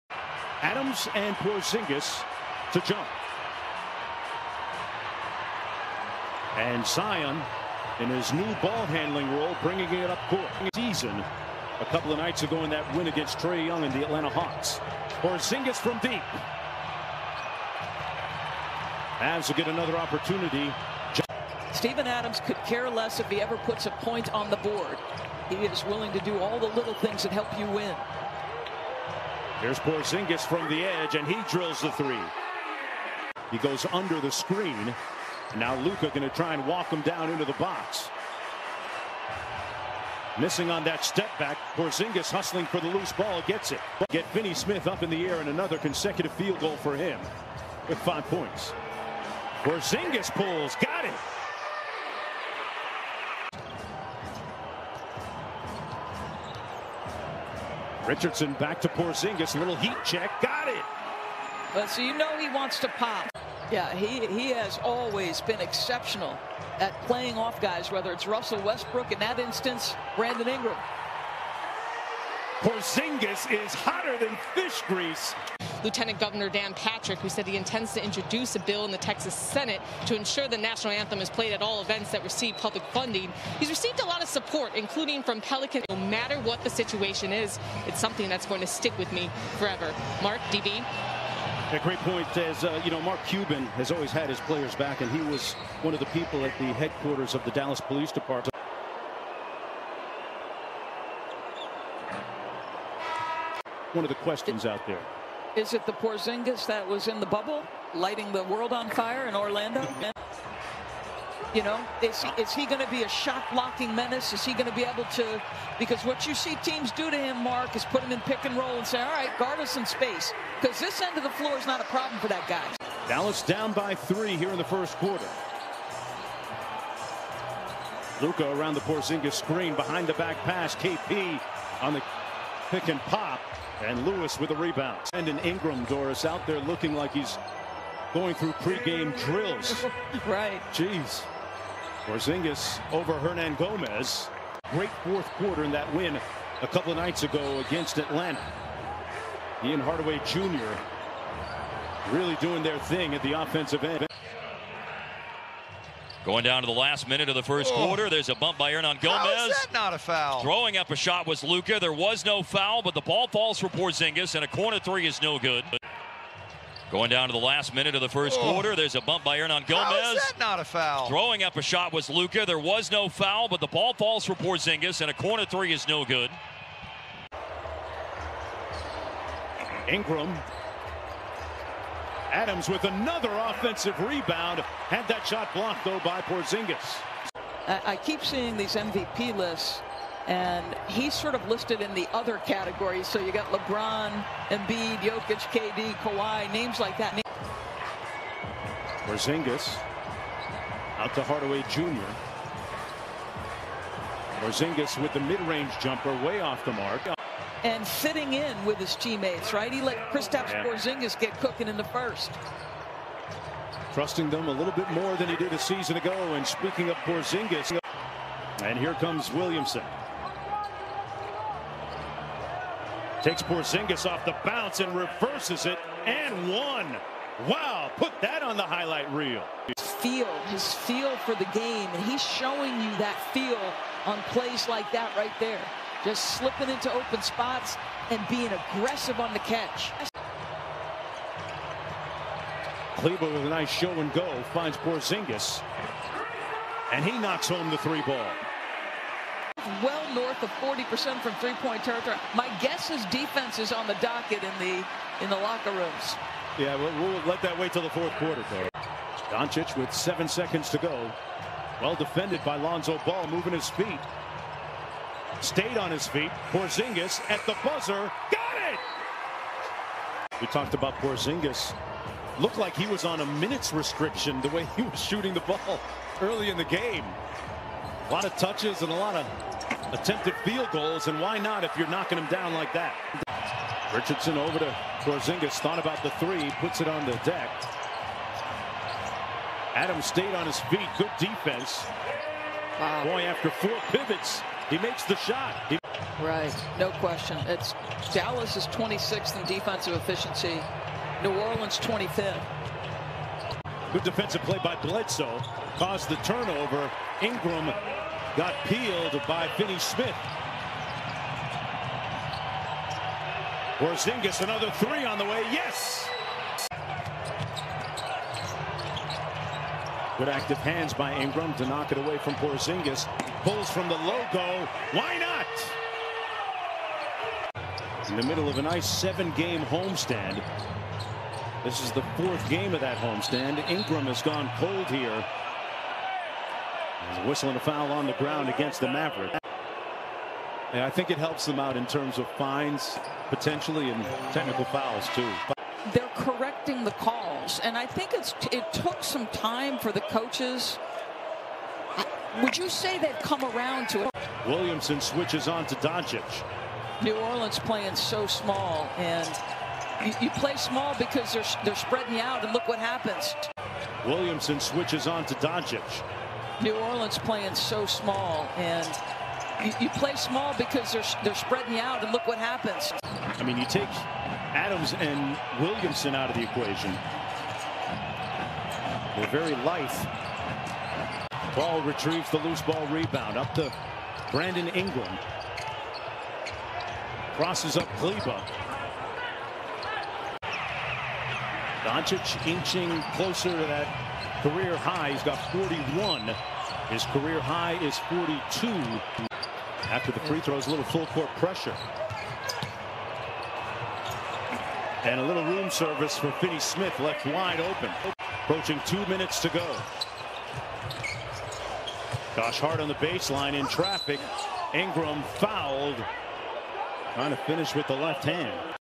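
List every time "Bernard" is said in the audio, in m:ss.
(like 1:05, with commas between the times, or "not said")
not said.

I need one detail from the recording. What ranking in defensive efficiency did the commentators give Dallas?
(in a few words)
26th.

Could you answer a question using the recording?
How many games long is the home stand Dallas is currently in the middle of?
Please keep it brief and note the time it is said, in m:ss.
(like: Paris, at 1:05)
7, at 5:28.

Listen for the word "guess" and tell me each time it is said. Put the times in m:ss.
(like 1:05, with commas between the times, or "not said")
4:12.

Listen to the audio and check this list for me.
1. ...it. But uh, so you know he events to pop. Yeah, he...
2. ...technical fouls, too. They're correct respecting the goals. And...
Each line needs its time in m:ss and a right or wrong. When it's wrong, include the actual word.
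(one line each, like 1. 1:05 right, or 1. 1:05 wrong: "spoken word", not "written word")
1. 1:00 wrong: "wants", not "events"
2. 5:44 wrong: "calls", not "goals".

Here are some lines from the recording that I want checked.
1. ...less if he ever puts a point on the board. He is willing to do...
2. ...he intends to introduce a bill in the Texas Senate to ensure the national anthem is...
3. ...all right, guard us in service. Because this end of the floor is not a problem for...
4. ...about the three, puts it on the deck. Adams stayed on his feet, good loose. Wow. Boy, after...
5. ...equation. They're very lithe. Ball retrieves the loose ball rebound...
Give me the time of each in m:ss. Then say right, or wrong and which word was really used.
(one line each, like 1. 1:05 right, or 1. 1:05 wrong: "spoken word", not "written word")
1. 0:22 right
2. 1:17 right
3. 1:59 wrong: "space", not "service"
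4. 4:45 wrong: "defense", not "loose"
5. 6:16 right.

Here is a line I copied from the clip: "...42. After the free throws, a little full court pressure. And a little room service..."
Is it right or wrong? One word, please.
right.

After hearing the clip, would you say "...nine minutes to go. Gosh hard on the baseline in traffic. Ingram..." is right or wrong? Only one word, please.
wrong.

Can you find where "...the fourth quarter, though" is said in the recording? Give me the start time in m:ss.
4:17.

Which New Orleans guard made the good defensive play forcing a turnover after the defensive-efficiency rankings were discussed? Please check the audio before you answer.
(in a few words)
Bledsoe.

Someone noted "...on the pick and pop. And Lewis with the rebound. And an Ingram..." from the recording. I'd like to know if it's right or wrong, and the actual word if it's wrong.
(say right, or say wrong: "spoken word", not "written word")
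right.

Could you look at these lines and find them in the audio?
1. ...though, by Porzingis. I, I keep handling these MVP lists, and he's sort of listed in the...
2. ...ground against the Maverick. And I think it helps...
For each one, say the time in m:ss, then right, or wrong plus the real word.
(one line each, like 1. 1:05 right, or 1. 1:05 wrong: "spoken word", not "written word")
1. 3:05 wrong: "seeing", not "handling"
2. 5:38 right.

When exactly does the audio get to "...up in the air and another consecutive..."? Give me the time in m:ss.
0:44.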